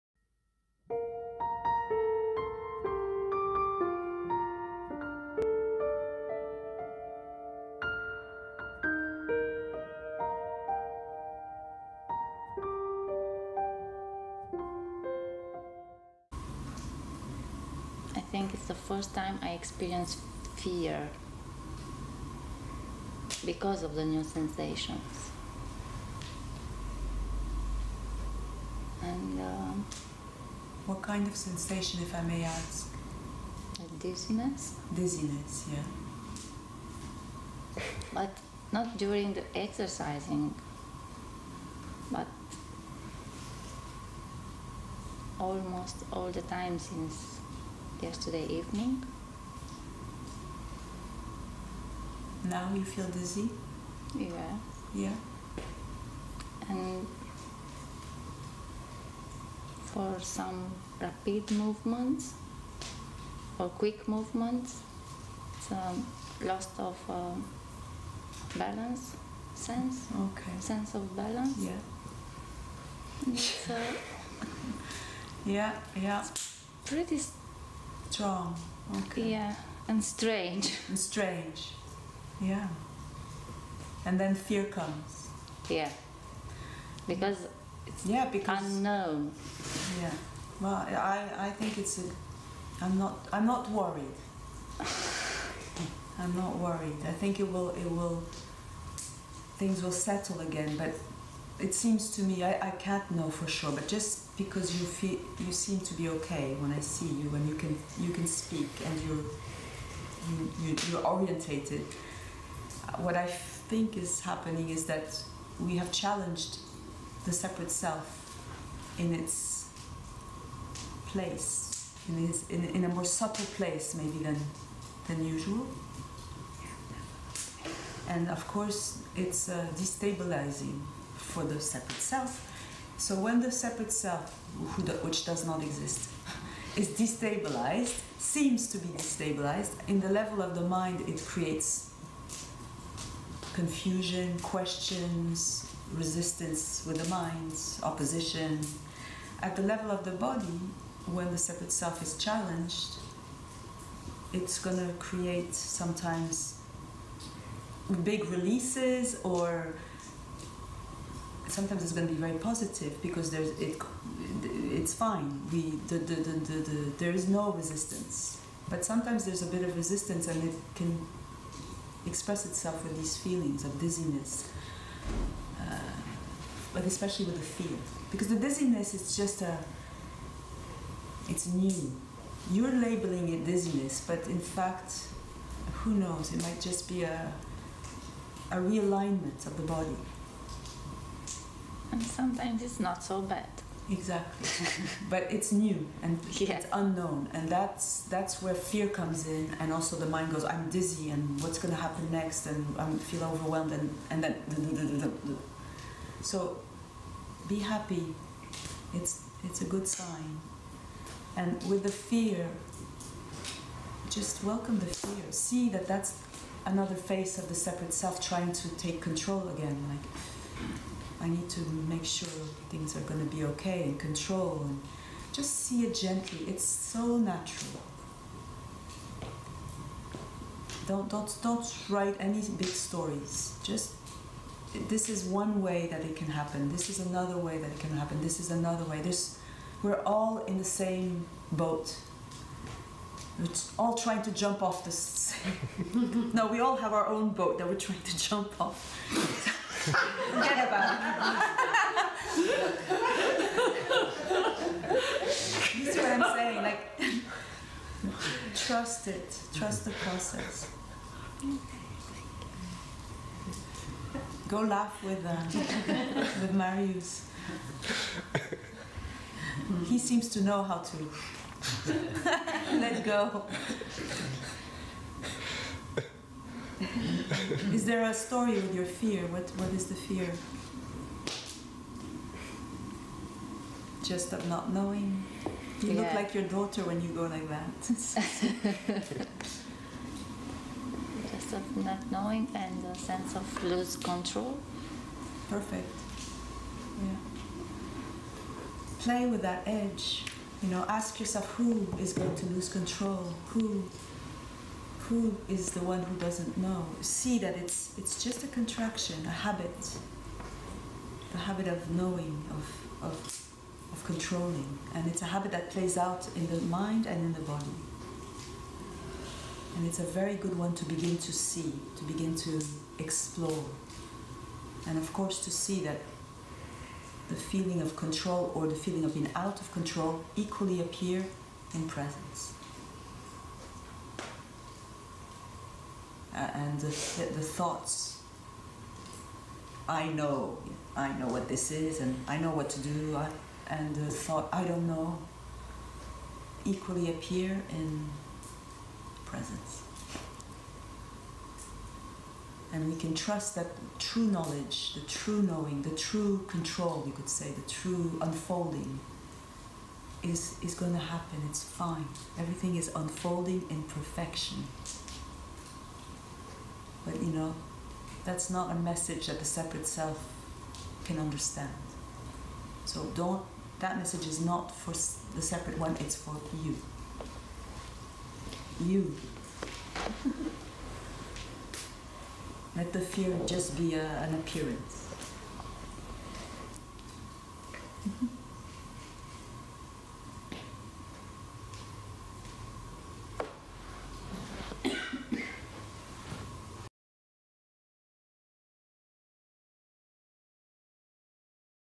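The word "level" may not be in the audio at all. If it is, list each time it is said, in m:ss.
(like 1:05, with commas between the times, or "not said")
2:20, 2:29.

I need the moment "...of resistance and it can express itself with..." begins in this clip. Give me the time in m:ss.
2:49.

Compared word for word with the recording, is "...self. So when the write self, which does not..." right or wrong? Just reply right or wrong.
wrong.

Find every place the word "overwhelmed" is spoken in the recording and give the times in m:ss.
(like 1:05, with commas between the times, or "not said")
3:23.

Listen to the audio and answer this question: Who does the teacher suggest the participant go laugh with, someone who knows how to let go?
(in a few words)
Marius.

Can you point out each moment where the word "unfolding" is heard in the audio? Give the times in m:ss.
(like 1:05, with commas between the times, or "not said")
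5:58, 6:02.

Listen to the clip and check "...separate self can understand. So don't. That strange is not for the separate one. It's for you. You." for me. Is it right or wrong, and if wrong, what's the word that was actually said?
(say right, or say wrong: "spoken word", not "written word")
wrong: "message", not "strange".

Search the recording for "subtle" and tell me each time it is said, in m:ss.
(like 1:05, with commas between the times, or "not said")
2:03.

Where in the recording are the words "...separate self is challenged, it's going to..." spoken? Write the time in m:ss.
2:31.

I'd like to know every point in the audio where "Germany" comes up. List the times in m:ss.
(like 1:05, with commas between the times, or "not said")
not said.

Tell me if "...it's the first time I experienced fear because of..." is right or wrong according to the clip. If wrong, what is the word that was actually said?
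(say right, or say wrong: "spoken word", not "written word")
right.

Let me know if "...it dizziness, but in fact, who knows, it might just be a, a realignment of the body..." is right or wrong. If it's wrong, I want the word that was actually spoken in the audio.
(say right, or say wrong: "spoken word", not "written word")
right.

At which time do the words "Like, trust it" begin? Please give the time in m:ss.
4:16.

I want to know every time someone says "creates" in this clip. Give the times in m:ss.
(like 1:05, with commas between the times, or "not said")
2:21, 2:34.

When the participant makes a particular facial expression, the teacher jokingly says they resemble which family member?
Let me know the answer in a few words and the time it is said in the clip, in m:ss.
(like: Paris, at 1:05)
daughter, at 4:46.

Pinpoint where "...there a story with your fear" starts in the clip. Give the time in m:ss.
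4:37.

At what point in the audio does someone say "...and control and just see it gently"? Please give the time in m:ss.
3:43.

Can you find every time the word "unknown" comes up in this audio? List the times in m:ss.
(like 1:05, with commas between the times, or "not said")
1:28, 3:16.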